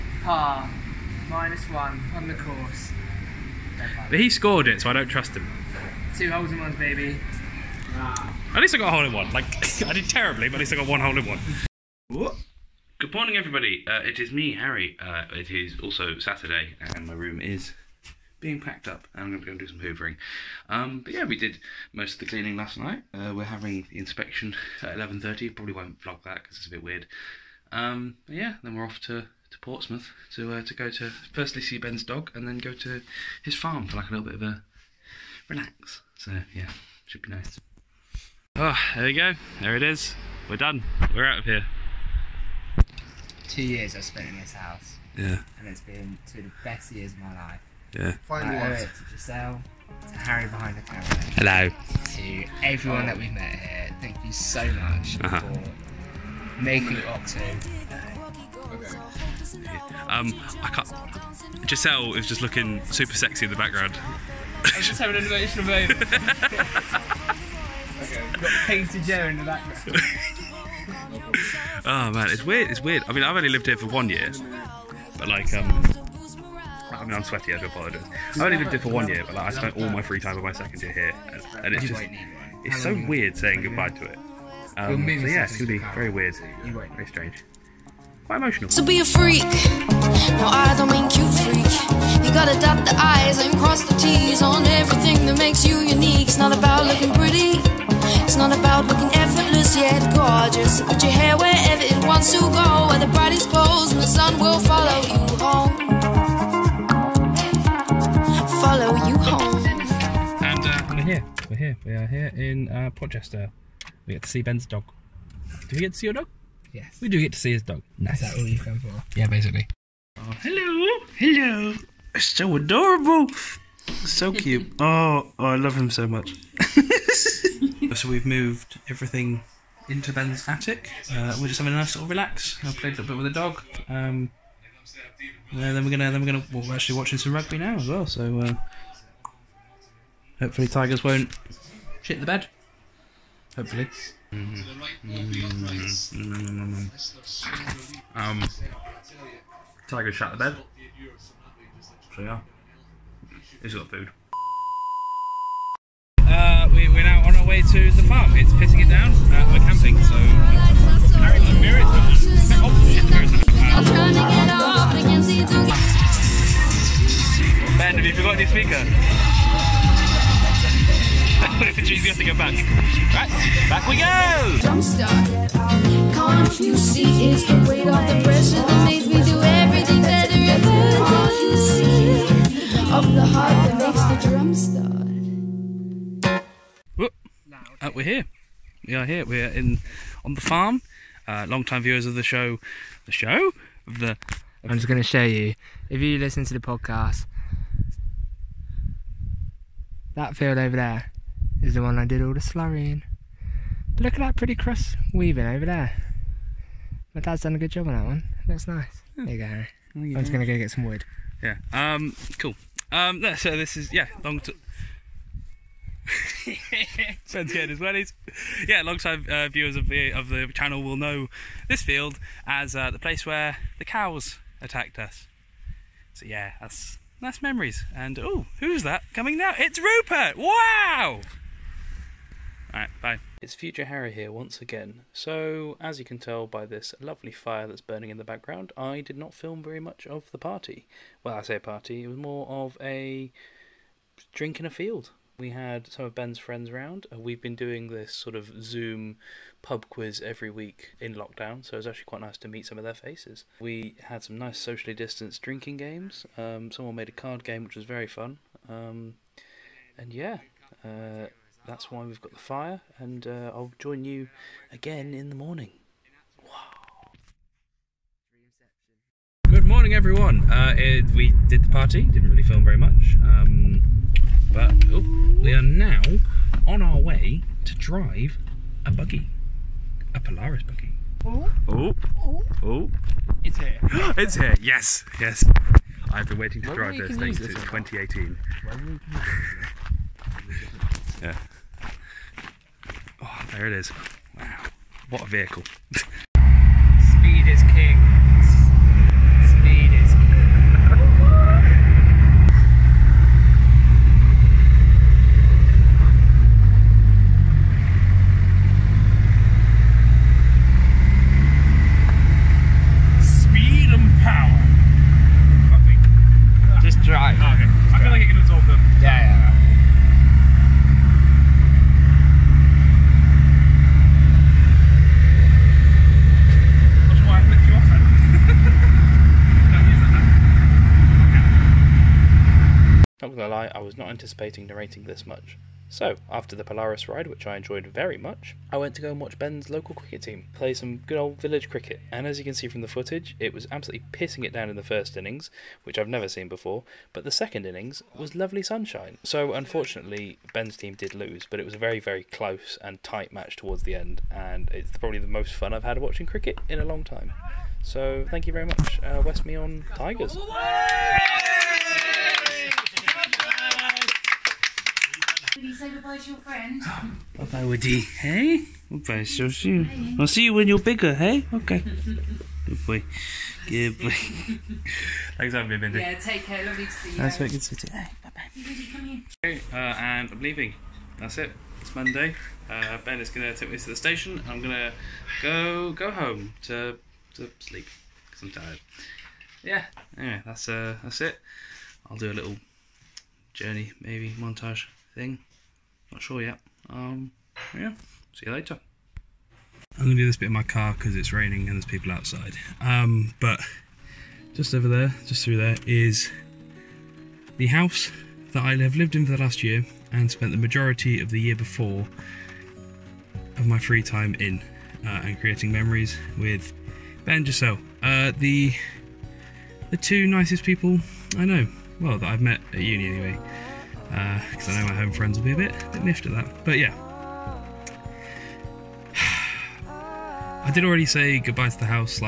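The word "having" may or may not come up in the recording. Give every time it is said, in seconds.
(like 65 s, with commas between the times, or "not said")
23 s, 64 s, 131 s, 375 s.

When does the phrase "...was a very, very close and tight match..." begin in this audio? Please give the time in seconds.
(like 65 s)
351 s.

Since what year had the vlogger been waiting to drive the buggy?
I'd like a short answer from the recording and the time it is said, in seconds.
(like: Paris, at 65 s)
2018, at 287 s.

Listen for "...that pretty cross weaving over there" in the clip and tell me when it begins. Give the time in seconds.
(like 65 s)
204 s.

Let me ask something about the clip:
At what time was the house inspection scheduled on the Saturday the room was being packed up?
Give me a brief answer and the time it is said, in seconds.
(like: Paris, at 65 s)
11:30, at 24 s.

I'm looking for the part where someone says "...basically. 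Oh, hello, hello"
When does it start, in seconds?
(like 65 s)
119 s.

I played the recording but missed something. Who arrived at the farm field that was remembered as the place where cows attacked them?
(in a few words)
Rupert.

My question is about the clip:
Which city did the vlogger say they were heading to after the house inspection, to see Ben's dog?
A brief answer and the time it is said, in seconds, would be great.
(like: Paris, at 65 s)
Portsmouth, at 29 s.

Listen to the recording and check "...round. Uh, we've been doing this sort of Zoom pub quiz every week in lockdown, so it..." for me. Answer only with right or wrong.
right.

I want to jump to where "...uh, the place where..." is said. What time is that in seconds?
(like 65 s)
222 s.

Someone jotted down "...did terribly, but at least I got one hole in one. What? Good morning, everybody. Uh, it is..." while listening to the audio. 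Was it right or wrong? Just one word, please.
right.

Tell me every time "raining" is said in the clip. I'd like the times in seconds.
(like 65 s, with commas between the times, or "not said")
401 s.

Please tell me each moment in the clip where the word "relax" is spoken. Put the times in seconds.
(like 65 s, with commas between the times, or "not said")
35 s, 132 s.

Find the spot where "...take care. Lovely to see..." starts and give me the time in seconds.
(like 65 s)
376 s.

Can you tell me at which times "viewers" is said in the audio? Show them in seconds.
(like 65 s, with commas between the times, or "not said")
191 s, 219 s.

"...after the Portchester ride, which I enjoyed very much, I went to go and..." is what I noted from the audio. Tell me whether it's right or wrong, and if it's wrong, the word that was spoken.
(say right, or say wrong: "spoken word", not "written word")
wrong: "Polaris", not "Portchester".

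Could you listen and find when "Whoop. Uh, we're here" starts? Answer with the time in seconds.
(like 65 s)
186 s.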